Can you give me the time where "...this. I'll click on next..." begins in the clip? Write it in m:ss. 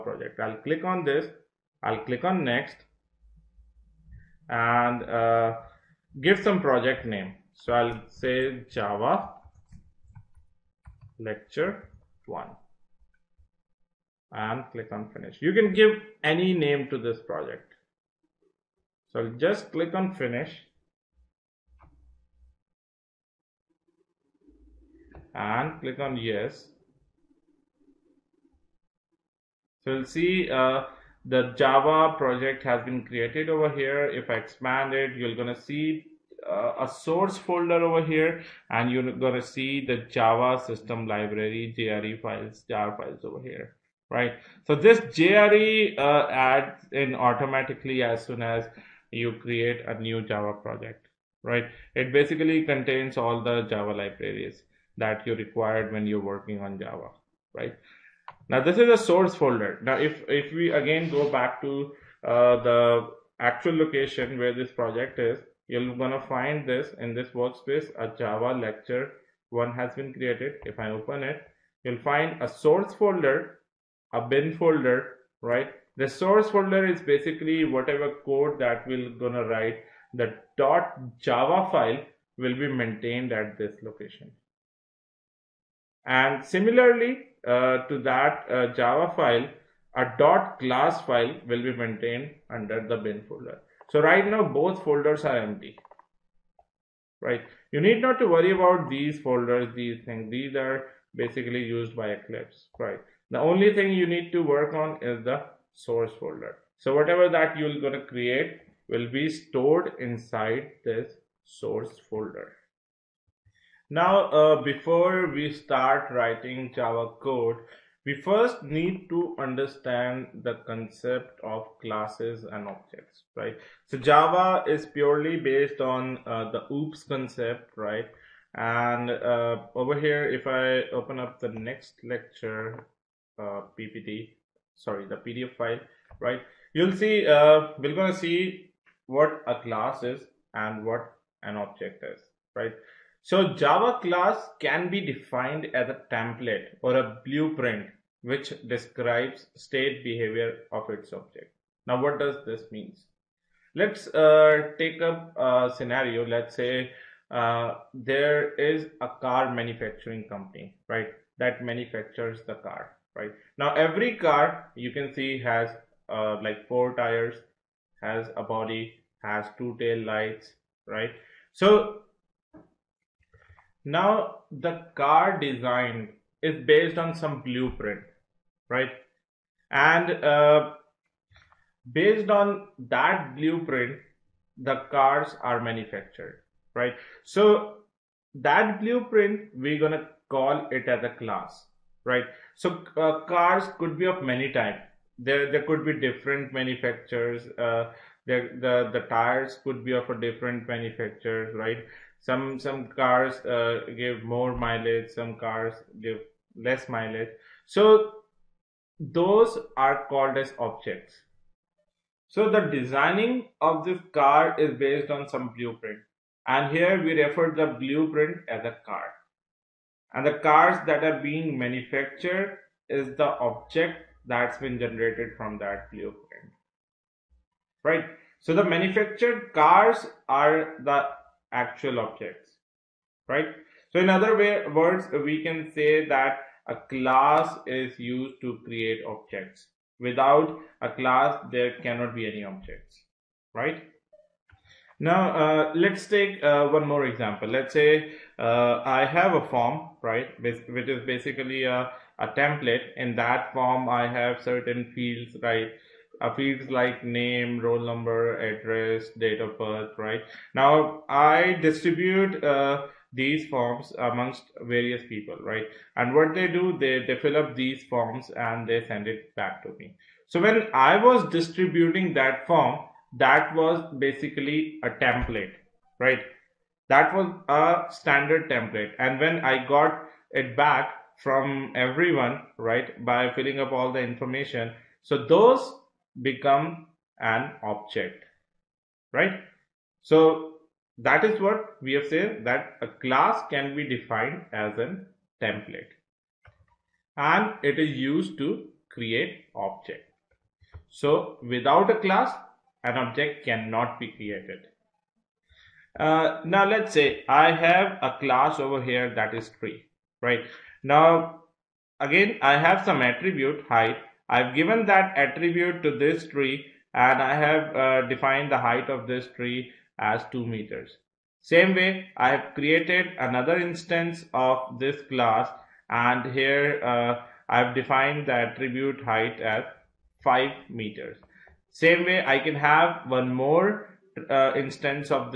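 0:01.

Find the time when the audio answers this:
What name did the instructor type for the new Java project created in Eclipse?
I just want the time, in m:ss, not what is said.
0:08.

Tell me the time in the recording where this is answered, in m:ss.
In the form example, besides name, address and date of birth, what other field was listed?
4:17.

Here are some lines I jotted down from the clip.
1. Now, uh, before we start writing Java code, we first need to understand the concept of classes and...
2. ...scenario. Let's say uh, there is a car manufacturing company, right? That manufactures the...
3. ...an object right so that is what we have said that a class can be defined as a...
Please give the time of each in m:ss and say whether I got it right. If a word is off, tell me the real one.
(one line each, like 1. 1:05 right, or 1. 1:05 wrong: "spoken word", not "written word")
1. 1:53 right
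2. 2:35 right
3. 4:47 right.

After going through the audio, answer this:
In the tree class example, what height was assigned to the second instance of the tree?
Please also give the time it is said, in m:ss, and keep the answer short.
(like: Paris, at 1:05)
5 meters, at 5:30.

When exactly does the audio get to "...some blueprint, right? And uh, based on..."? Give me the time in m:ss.
2:57.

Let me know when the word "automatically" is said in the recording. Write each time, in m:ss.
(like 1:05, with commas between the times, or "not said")
0:47.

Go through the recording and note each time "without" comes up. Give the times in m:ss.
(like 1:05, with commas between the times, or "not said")
3:59, 5:01.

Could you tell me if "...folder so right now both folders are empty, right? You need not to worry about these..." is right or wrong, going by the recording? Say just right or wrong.
right.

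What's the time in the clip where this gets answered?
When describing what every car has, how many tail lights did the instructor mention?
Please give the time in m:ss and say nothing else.
2:49.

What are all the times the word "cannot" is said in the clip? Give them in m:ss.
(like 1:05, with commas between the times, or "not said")
4:01, 5:03.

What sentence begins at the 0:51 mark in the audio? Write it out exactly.
It basically contains all the Java libraries that you required when you're working on Java, right?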